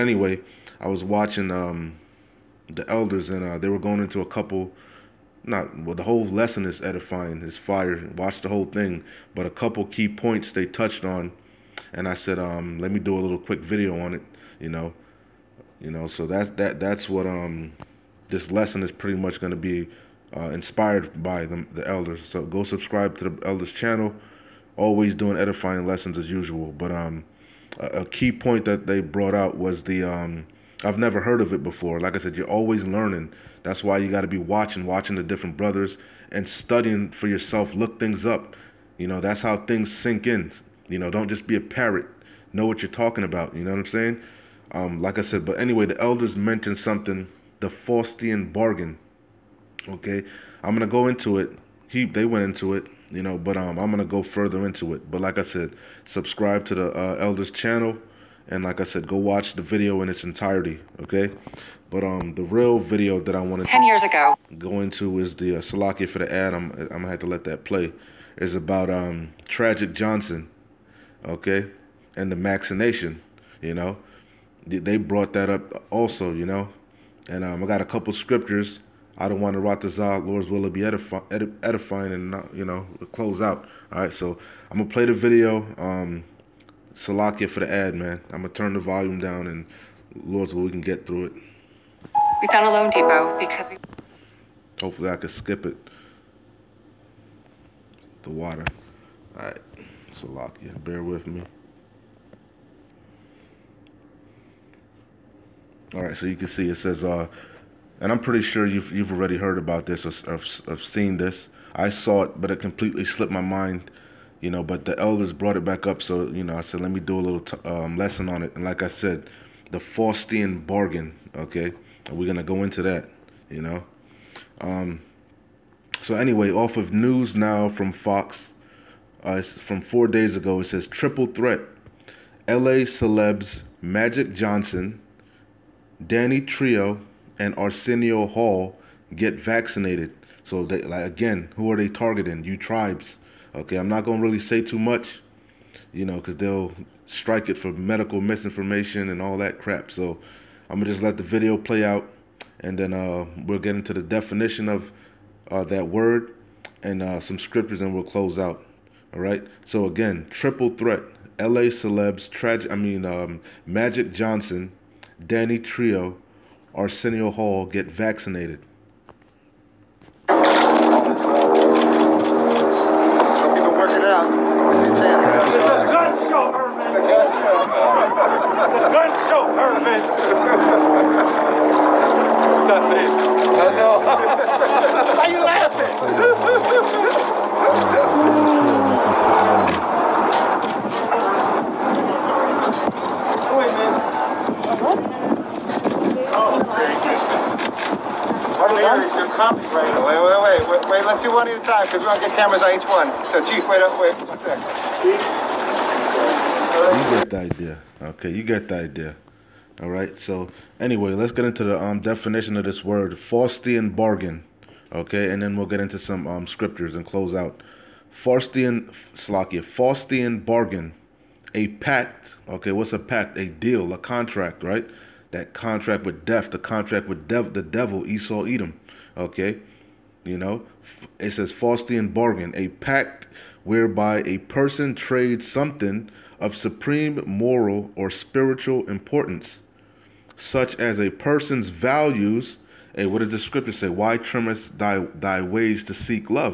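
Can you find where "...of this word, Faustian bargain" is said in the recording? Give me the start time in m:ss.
3:32.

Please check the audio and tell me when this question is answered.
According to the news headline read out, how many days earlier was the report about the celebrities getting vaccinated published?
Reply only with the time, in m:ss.
2:09.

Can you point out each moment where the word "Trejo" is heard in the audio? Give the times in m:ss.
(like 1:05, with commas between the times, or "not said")
2:16, 2:45.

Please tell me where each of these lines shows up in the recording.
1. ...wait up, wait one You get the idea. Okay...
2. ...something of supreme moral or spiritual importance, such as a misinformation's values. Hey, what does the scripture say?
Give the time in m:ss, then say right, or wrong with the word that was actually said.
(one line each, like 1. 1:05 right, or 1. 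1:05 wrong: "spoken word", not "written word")
1. 3:23 right
2. 3:55 wrong: "person", not "misinformation".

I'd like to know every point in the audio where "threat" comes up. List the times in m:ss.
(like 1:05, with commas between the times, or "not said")
2:11, 2:40.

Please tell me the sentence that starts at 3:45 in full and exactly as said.
That contract with death, the contract with dev, the devil, Esau, Edom.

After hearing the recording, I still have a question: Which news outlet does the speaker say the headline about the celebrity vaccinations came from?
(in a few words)
Fox.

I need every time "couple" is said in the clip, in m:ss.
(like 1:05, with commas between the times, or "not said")
0:04, 0:09, 1:17.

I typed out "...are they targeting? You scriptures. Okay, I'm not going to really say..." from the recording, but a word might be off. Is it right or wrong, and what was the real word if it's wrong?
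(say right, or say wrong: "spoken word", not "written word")
wrong: "tribes", not "scriptures".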